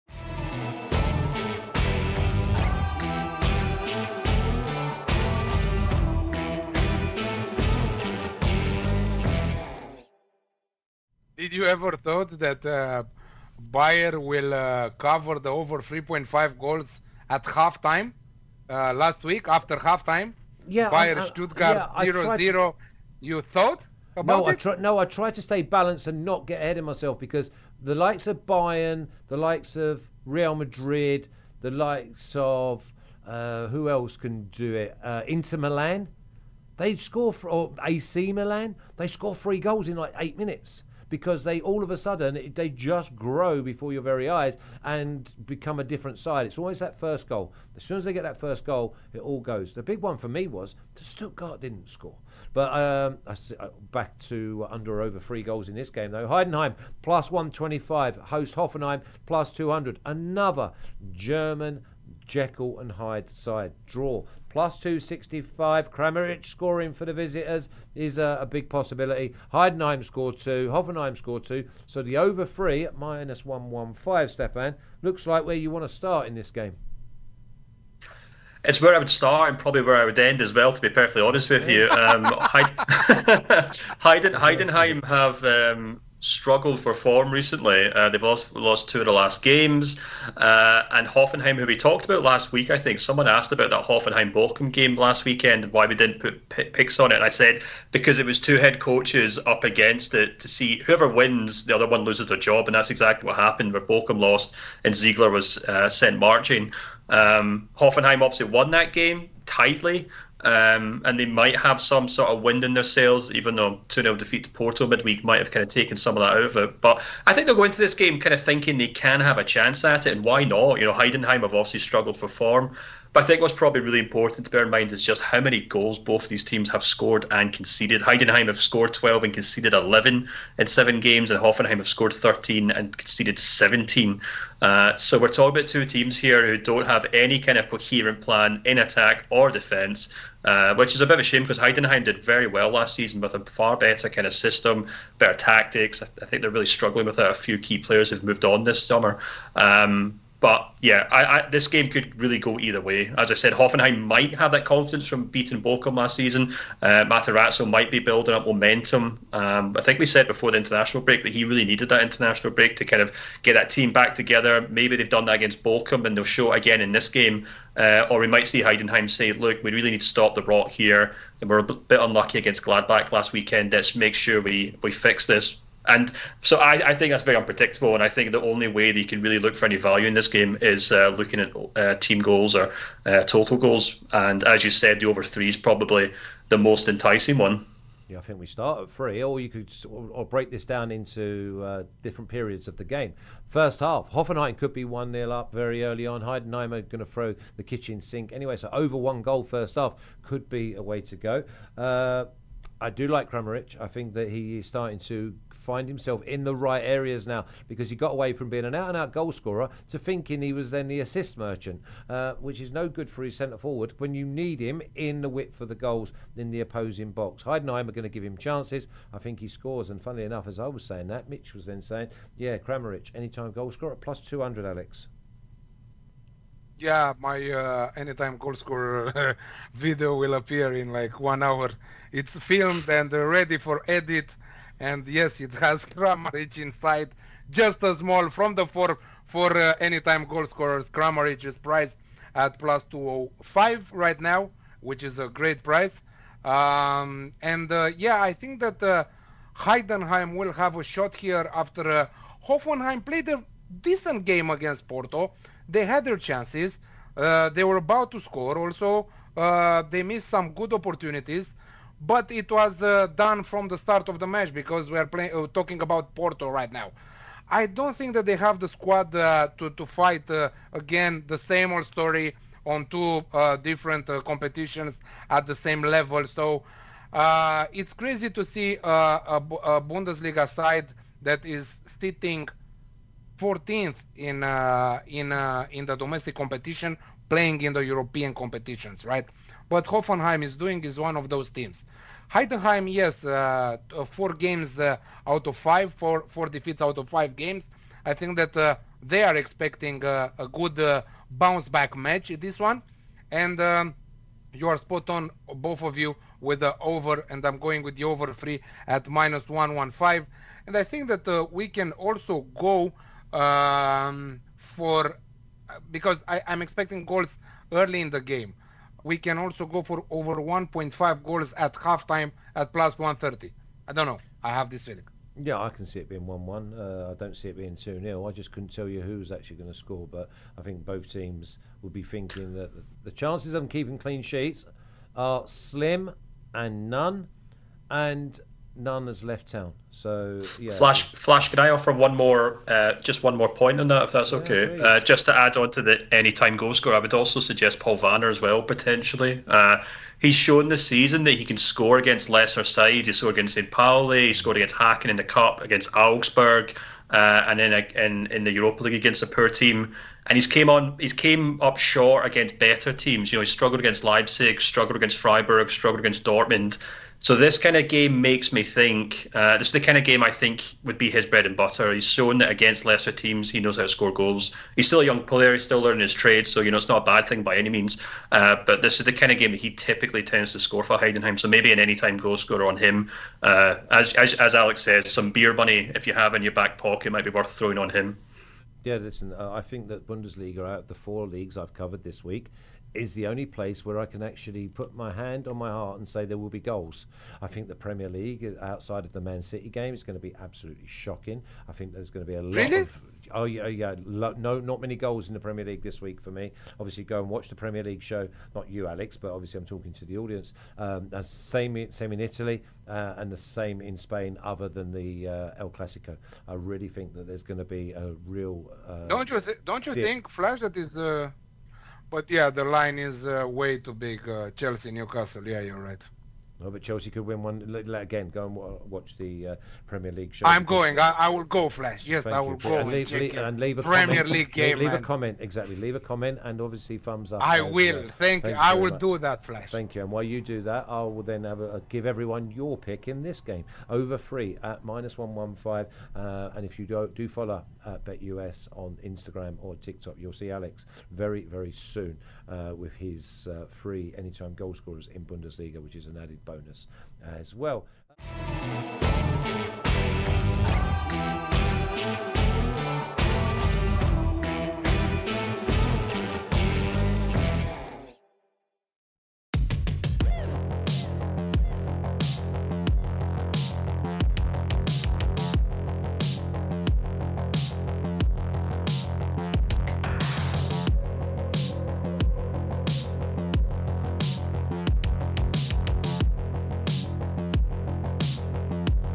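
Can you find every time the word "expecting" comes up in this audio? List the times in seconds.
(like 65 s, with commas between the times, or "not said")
299 s, 316 s.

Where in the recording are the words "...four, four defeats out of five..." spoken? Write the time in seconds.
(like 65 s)
295 s.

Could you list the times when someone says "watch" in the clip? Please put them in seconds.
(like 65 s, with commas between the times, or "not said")
407 s, 428 s.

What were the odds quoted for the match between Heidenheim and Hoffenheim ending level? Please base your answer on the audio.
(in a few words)
+265.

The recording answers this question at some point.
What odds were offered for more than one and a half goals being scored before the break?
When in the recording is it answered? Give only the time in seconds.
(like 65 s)
322 s.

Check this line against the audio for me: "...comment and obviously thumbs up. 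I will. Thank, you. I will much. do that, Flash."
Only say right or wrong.
right.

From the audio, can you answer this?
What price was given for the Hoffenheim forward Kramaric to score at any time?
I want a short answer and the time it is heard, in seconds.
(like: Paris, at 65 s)
+205, at 242 s.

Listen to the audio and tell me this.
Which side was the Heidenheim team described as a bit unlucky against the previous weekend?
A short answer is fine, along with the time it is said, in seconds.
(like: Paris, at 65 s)
Gladbach, at 172 s.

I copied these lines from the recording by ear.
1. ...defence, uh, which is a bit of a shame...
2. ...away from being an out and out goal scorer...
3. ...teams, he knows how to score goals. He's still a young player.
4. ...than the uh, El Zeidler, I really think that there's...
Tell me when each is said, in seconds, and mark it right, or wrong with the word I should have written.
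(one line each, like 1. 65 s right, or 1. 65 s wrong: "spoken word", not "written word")
1. 139 s right
2. 208 s right
3. 373 s right
4. 414 s wrong: "Clasico", not "Zeidler".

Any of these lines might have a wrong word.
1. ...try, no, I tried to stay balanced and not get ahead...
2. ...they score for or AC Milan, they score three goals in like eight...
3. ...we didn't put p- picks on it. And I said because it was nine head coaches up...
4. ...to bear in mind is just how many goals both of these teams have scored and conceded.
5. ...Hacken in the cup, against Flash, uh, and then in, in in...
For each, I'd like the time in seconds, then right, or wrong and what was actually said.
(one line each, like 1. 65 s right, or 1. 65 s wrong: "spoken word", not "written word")
1. 24 s right
2. 36 s right
3. 95 s wrong: "two", not "nine"
4. 124 s right
5. 354 s wrong: "Augsburg", not "Flash".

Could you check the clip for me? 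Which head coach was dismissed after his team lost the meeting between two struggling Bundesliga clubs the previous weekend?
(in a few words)
Zeidler.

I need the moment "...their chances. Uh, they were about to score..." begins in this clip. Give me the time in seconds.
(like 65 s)
256 s.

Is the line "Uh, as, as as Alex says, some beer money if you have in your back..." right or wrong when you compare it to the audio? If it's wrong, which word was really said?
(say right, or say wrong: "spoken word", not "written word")
right.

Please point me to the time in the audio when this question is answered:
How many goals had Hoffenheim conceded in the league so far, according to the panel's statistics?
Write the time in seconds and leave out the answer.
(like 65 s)
133 s.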